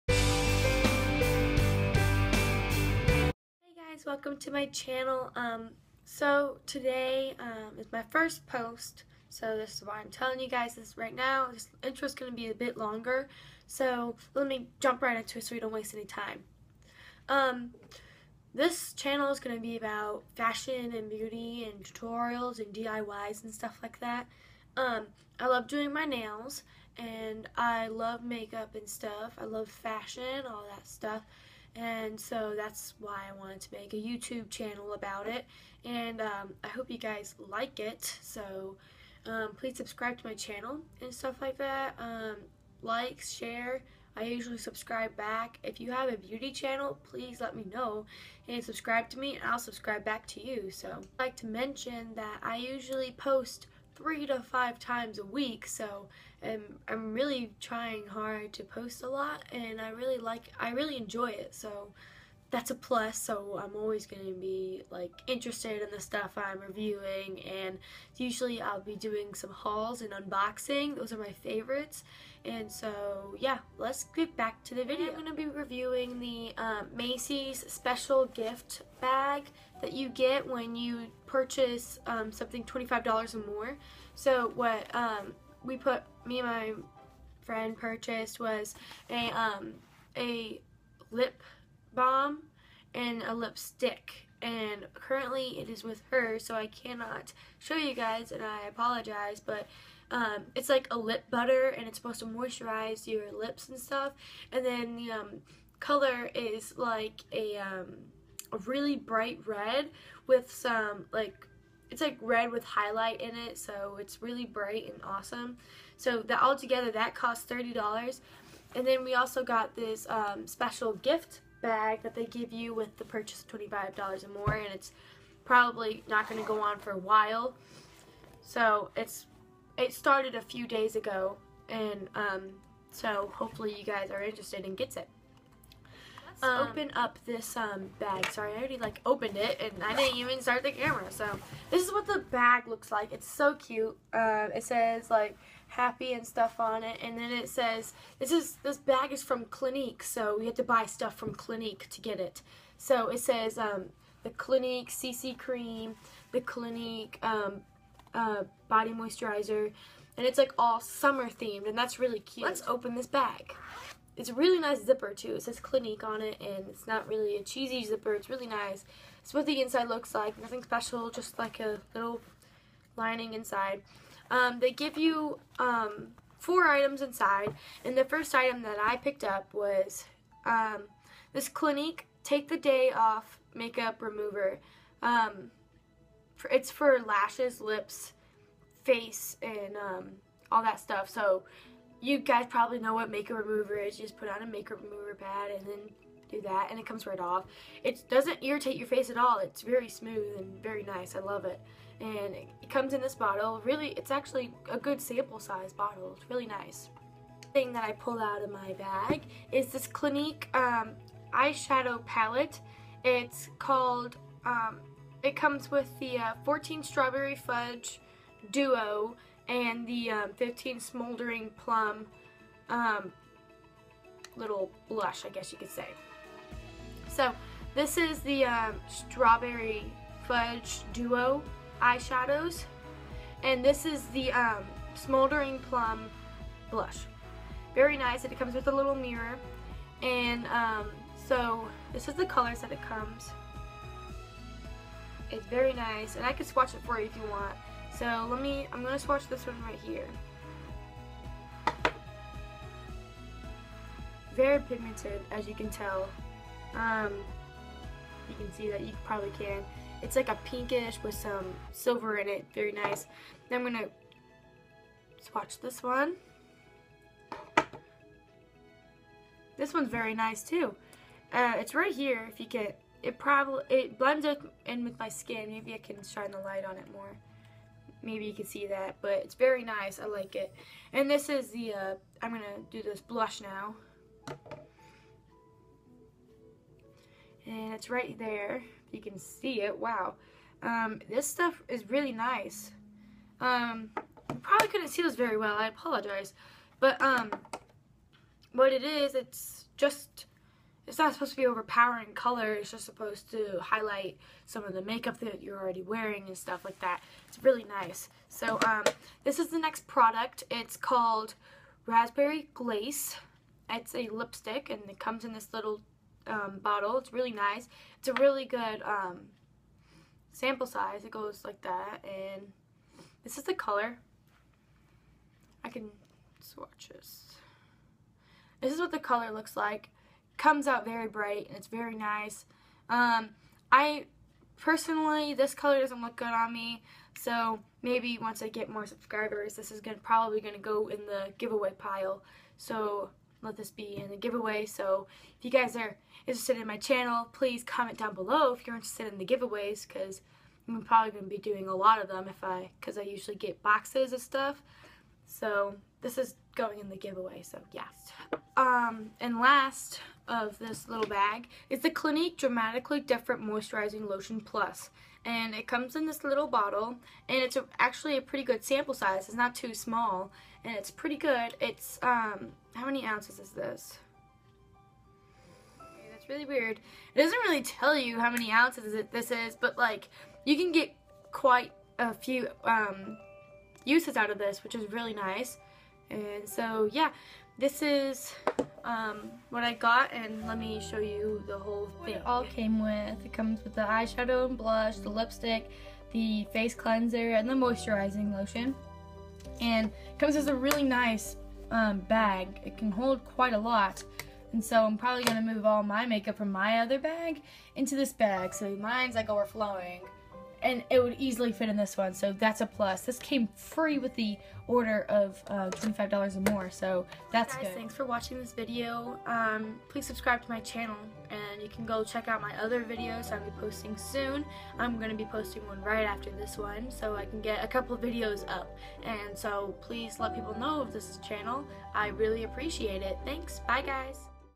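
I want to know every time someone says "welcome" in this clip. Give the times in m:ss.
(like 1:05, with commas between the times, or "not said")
0:04.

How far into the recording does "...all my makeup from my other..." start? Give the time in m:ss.
6:45.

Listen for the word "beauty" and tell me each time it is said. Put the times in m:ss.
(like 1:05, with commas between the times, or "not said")
0:21, 0:46.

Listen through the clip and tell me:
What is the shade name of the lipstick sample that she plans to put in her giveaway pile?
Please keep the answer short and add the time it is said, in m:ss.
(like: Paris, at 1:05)
Raspberry Glaze, at 5:11.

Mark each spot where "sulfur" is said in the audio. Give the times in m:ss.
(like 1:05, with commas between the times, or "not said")
not said.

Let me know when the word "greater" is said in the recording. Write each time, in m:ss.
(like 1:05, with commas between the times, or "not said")
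not said.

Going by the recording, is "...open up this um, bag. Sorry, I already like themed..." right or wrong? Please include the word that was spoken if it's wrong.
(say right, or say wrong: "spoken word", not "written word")
wrong: "opened", not "themed".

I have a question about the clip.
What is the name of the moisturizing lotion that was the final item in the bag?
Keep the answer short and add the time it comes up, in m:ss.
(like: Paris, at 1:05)
Dramatically Different Moisturizing Lotion Plus, at 6:02.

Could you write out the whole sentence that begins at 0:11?
This intro is going to be a bit longer, so let me jump right into it so we don't waste any time.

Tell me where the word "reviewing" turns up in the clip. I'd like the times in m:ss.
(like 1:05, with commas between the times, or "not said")
1:06, 1:15.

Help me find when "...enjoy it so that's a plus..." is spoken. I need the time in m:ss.
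1:00.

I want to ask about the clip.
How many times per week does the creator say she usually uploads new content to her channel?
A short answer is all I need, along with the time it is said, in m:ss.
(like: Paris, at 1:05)
3 to 5, at 0:54.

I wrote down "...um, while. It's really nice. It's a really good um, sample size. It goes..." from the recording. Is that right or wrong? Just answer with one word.
wrong.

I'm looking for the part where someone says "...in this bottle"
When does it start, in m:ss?
3:22.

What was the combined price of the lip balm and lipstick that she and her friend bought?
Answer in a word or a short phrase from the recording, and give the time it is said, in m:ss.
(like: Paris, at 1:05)
$30, at 1:57.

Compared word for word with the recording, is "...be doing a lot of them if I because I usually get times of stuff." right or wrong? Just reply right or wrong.
wrong.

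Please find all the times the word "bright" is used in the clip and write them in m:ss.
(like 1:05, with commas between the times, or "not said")
1:48, 1:54, 5:31.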